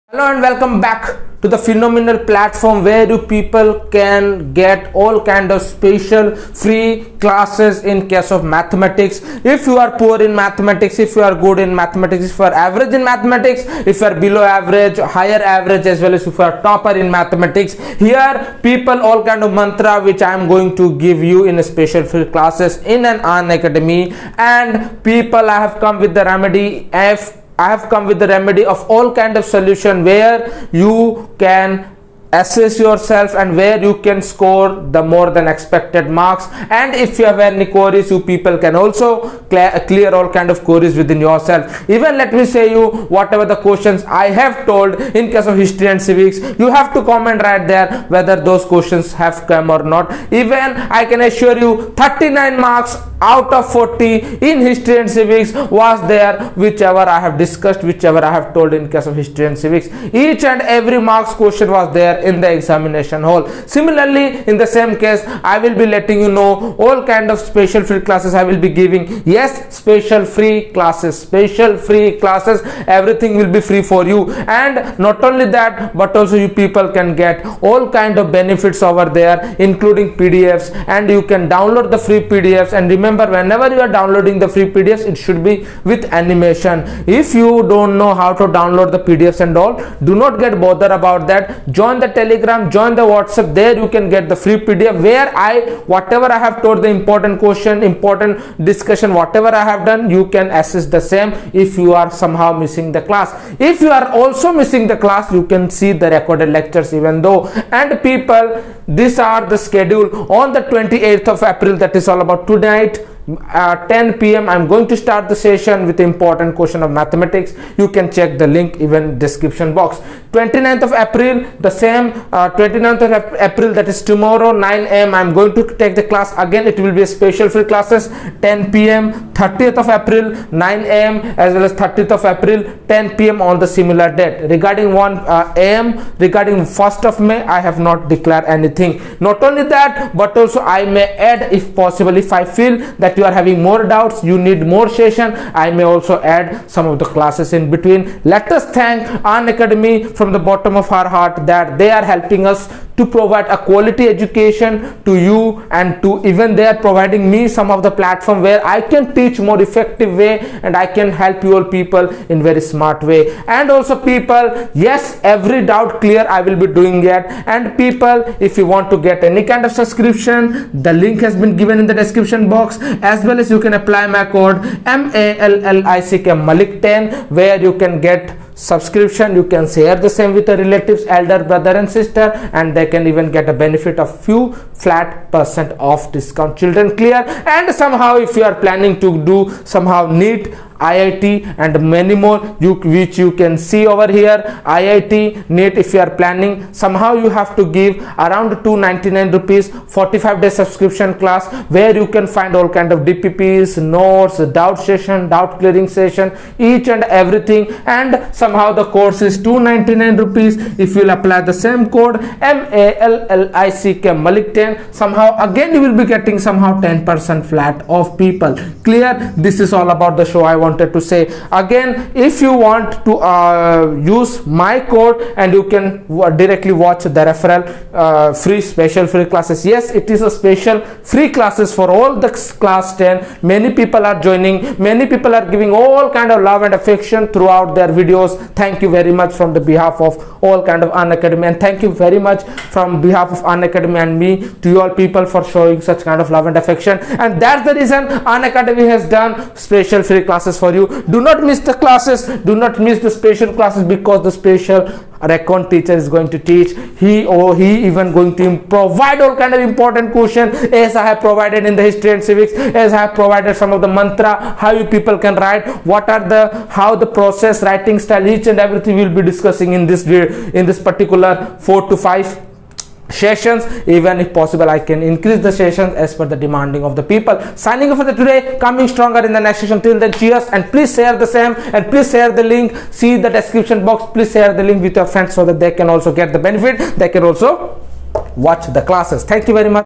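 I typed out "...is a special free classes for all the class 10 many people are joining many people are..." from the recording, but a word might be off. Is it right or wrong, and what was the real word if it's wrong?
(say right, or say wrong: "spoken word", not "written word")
right.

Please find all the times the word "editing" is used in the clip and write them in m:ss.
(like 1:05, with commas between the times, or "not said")
not said.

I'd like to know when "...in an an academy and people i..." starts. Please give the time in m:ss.
0:22.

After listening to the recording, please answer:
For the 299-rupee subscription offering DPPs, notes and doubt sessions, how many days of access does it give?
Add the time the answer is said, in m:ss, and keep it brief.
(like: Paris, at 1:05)
45 days, at 3:19.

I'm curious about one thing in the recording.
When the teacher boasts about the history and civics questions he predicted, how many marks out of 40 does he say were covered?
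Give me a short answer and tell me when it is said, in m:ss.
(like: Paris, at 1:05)
39, at 0:51.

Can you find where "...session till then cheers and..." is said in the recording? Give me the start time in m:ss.
4:39.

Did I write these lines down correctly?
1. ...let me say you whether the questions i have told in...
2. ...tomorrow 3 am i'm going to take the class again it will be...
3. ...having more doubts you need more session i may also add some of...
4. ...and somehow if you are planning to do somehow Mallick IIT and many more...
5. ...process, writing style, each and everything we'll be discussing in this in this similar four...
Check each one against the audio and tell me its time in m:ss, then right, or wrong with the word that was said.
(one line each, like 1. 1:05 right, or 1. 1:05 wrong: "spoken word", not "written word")
1. 0:42 wrong: "whatever", not "whether"
2. 2:04 wrong: "9", not "3"
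3. 2:23 right
4. 3:07 wrong: "NEET", not "Mallick"
5. 4:27 wrong: "particular", not "similar".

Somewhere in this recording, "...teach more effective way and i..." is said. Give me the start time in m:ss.
2:39.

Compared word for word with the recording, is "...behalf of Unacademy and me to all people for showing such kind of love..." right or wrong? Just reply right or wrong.
right.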